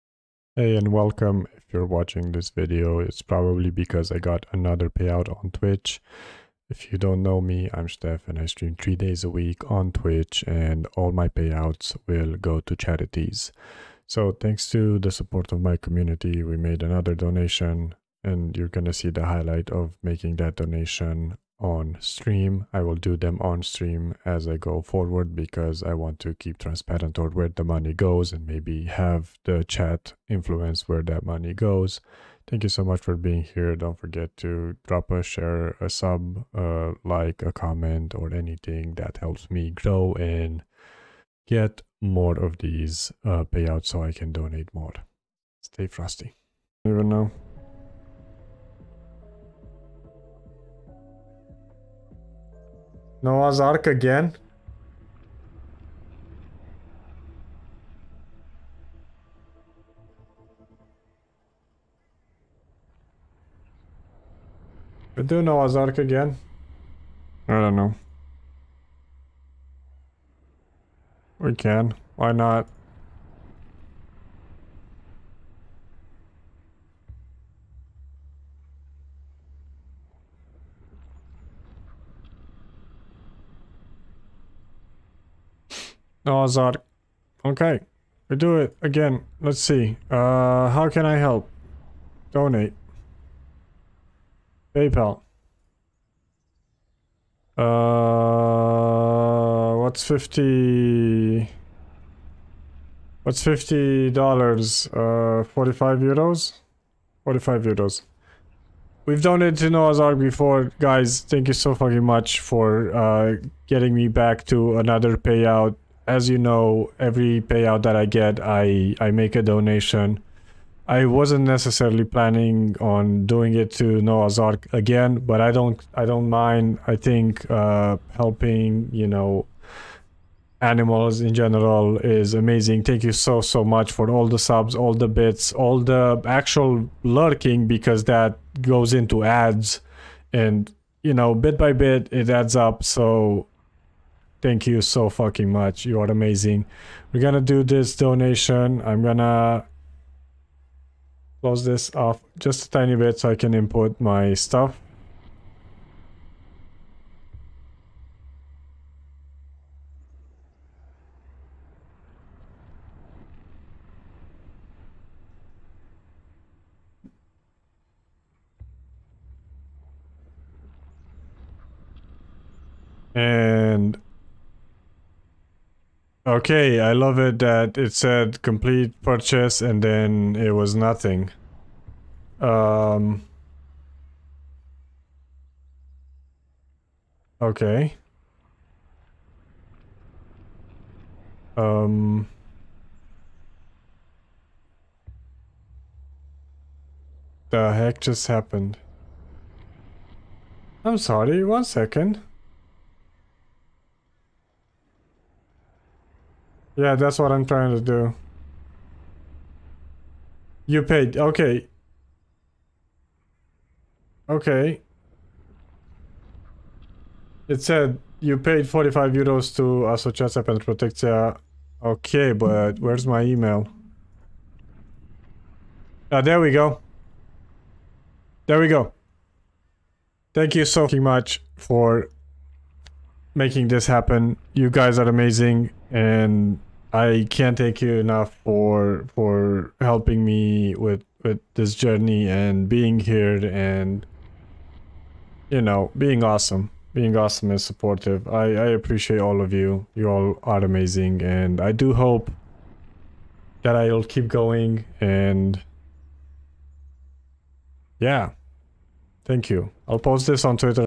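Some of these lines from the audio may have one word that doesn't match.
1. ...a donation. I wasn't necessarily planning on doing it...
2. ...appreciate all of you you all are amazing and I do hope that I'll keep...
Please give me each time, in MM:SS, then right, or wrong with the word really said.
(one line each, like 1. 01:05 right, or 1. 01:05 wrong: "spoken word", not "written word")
1. 01:59 right
2. 04:08 right.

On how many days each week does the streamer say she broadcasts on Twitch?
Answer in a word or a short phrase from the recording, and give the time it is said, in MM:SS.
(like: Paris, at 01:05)
3, at 00:08.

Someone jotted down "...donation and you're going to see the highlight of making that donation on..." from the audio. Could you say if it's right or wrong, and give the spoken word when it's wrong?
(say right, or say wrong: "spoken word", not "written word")
right.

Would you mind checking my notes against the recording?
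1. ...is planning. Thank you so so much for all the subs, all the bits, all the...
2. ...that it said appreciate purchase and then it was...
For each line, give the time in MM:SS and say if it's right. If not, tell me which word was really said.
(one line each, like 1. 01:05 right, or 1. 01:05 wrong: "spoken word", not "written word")
1. 02:11 wrong: "amazing", not "planning"
2. 02:57 wrong: "complete", not "appreciate".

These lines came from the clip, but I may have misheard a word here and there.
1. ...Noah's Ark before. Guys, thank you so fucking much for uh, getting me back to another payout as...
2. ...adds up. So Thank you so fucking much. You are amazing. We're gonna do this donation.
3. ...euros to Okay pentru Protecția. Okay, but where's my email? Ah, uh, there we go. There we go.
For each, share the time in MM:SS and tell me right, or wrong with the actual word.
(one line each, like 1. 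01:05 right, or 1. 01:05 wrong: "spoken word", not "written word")
1. 01:49 right
2. 02:22 right
3. 03:39 wrong: "Asociația", not "Okay".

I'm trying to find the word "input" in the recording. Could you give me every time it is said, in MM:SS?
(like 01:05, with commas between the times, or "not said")
02:33.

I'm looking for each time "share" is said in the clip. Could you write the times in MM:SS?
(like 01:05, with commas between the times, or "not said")
00:35.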